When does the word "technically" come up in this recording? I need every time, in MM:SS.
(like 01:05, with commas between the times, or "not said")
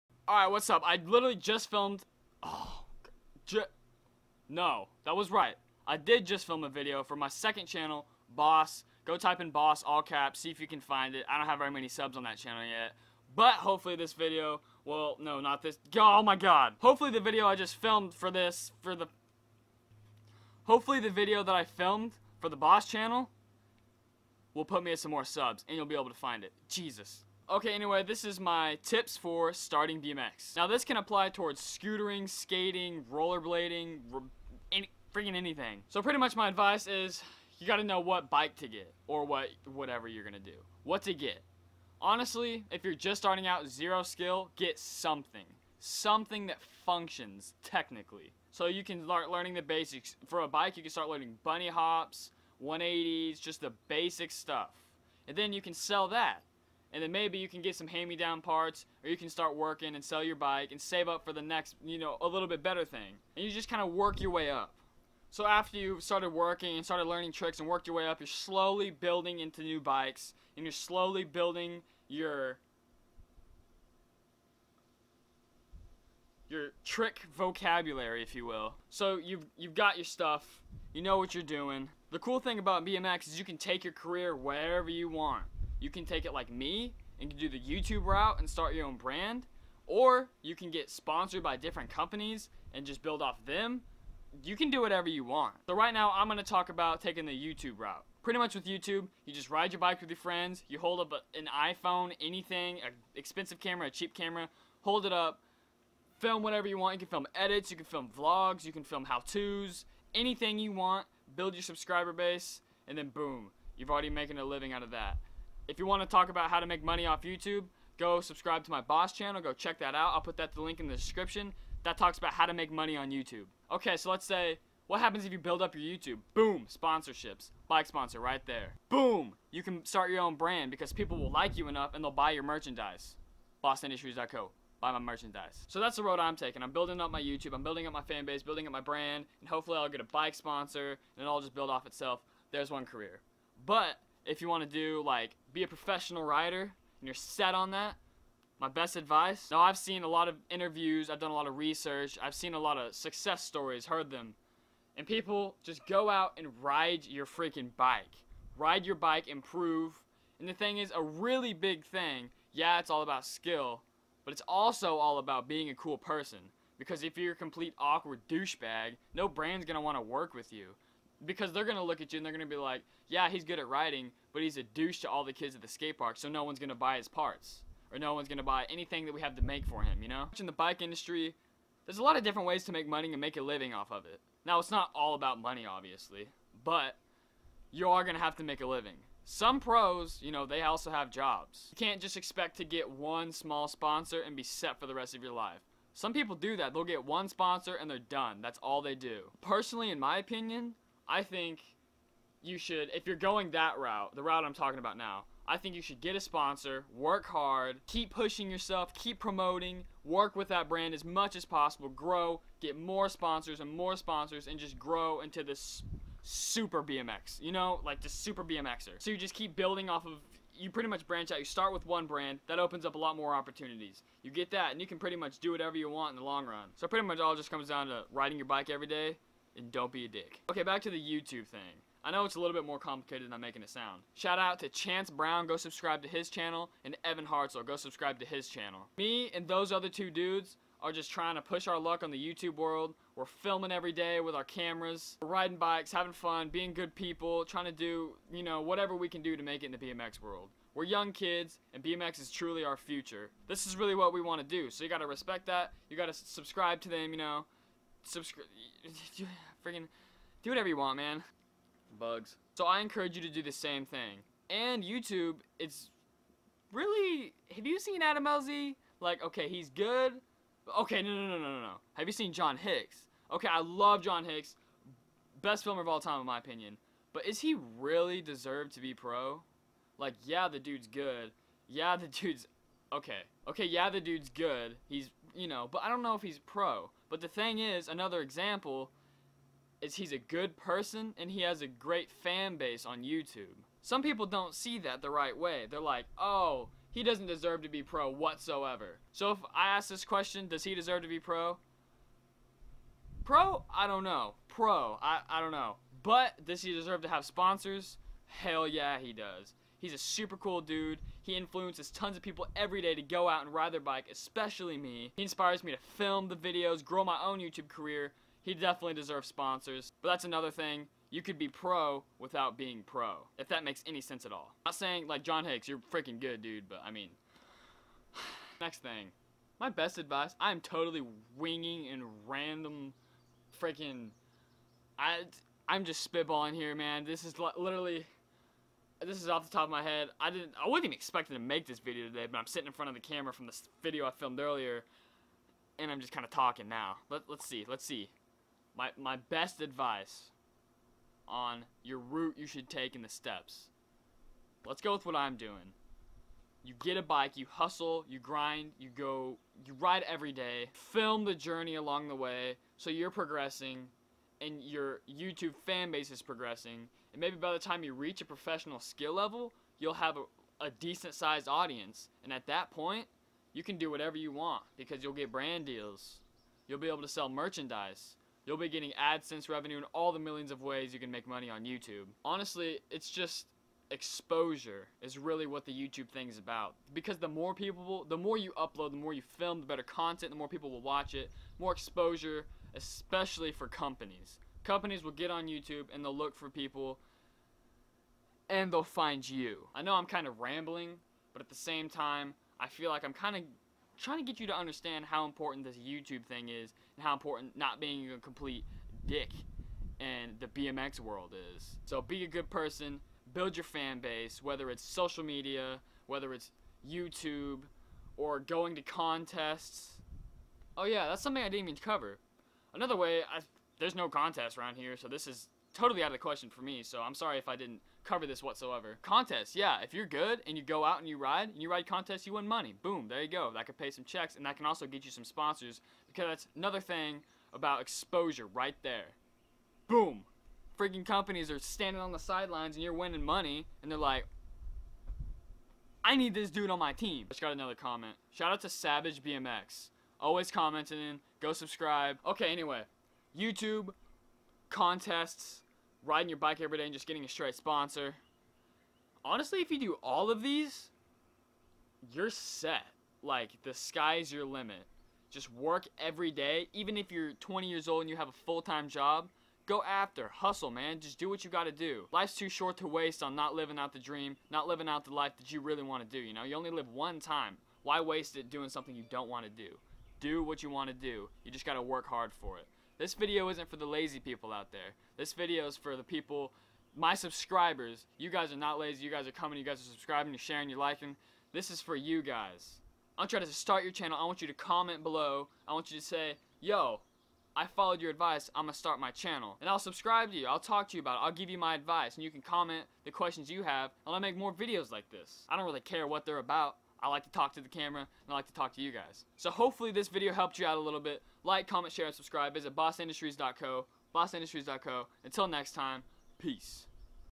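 00:47.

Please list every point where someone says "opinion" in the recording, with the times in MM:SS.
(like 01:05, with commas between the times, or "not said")
03:20, 04:36.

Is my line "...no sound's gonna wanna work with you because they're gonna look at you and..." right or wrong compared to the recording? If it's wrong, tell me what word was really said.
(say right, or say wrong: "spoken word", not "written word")
wrong: "brand", not "sound".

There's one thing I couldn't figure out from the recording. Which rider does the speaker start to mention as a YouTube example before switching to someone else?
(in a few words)
Adam LZ.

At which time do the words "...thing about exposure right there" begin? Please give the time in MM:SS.
07:16.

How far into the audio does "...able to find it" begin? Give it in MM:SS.
00:25.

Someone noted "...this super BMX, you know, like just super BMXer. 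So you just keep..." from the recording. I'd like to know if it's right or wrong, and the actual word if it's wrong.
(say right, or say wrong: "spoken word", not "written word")
right.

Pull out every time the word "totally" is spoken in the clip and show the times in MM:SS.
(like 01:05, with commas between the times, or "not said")
05:30, 07:05.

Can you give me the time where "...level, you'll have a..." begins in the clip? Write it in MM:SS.
06:09.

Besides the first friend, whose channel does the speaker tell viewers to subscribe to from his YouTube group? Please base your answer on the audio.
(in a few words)
Evan Hartzell.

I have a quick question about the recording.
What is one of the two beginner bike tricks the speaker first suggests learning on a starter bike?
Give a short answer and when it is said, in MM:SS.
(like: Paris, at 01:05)
Bunny hops, at 00:51.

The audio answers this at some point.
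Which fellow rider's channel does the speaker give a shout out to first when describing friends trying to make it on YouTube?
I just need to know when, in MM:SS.
03:54.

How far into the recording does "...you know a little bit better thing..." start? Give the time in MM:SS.
01:01.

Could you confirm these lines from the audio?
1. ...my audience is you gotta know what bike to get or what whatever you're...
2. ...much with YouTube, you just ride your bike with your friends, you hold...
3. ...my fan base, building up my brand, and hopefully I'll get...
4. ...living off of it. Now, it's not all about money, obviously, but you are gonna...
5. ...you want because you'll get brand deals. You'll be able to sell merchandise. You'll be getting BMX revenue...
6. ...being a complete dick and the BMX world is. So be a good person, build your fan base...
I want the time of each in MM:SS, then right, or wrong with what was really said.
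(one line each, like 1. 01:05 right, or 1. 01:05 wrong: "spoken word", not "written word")
1. 00:36 wrong: "advice", not "audience"
2. 01:38 right
3. 02:17 right
4. 03:03 right
5. 06:14 wrong: "AdSense", not "BMX"
6. 06:47 right.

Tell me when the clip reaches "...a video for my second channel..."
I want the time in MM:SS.
00:06.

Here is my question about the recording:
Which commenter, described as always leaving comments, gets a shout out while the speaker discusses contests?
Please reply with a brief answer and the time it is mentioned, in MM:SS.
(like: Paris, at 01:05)
Savage BMX, at 07:28.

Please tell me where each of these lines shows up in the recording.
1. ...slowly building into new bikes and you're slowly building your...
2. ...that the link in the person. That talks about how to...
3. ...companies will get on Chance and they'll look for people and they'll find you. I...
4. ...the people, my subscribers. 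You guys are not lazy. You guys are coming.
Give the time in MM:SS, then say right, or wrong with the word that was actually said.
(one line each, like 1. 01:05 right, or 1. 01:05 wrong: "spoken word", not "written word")
1. 01:08 right
2. 02:00 wrong: "description", not "person"
3. 06:34 wrong: "YouTube", not "Chance"
4. 08:05 right.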